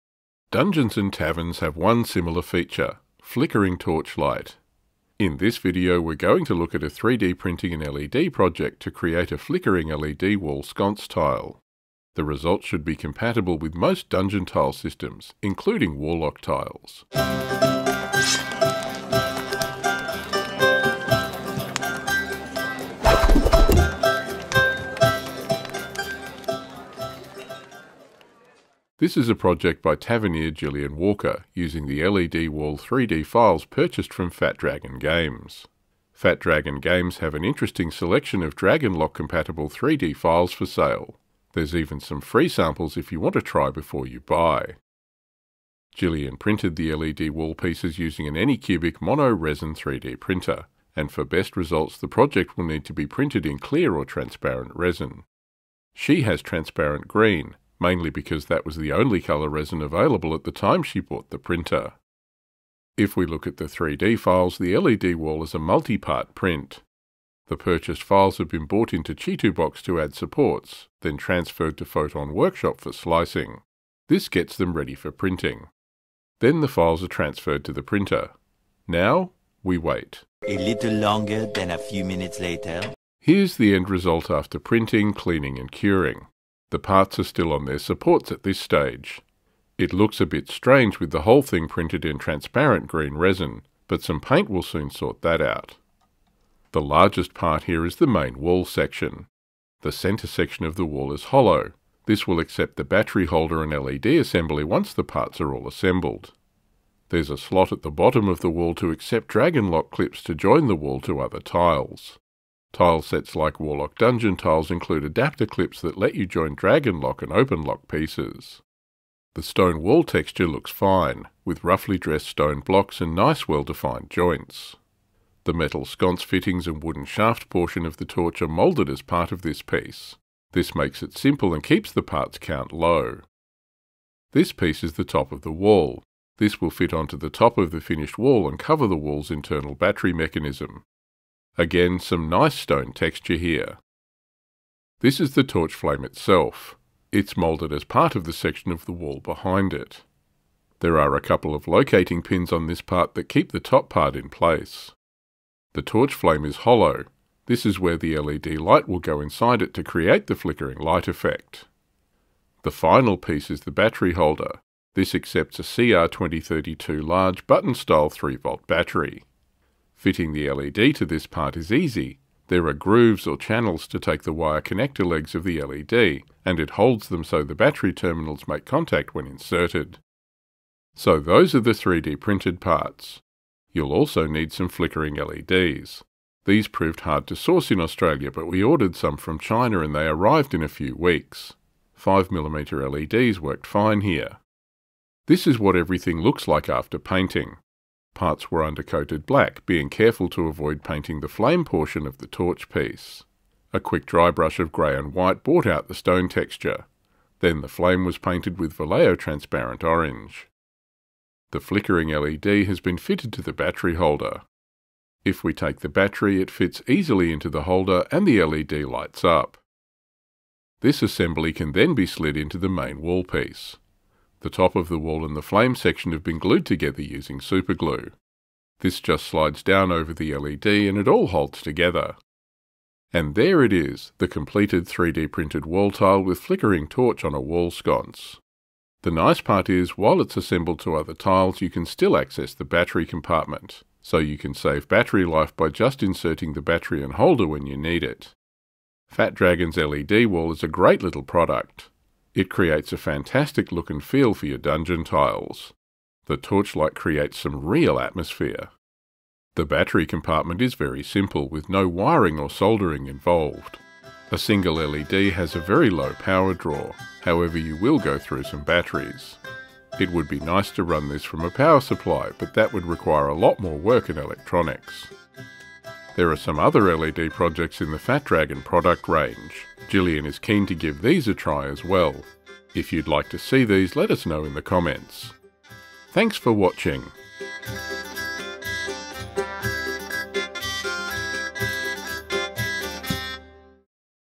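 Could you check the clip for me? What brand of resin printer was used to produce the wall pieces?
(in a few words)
Anycubic.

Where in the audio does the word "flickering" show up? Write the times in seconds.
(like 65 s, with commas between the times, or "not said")
3 s, 9 s, 160 s, 184 s, 211 s, 236 s.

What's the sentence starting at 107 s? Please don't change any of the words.
There's a slot at the bottom of the wall to accept dragon lock clips to join the wall to other tiles.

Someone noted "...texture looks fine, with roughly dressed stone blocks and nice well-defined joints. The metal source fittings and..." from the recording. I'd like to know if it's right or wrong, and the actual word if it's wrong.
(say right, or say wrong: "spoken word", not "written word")
wrong: "sconce", not "source".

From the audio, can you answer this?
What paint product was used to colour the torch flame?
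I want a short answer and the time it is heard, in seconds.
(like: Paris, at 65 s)
Vallejo transparent orange, at 208 s.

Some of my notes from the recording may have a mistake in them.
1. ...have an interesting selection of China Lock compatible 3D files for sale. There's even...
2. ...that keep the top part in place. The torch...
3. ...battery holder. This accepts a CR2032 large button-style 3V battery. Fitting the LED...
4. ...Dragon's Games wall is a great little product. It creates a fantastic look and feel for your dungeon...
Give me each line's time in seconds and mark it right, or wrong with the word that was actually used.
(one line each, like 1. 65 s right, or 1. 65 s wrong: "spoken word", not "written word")
1. 37 s wrong: "Dragon", not "China"
2. 153 s right
3. 163 s right
4. 249 s wrong: "LED", not "Games".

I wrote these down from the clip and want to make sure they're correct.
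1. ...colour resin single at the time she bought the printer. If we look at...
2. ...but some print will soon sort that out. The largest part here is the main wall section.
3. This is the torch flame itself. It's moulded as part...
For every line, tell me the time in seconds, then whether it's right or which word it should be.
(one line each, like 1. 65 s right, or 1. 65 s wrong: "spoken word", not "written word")
1. 59 s wrong: "available", not "single"
2. 93 s wrong: "paint", not "print"
3. 145 s right.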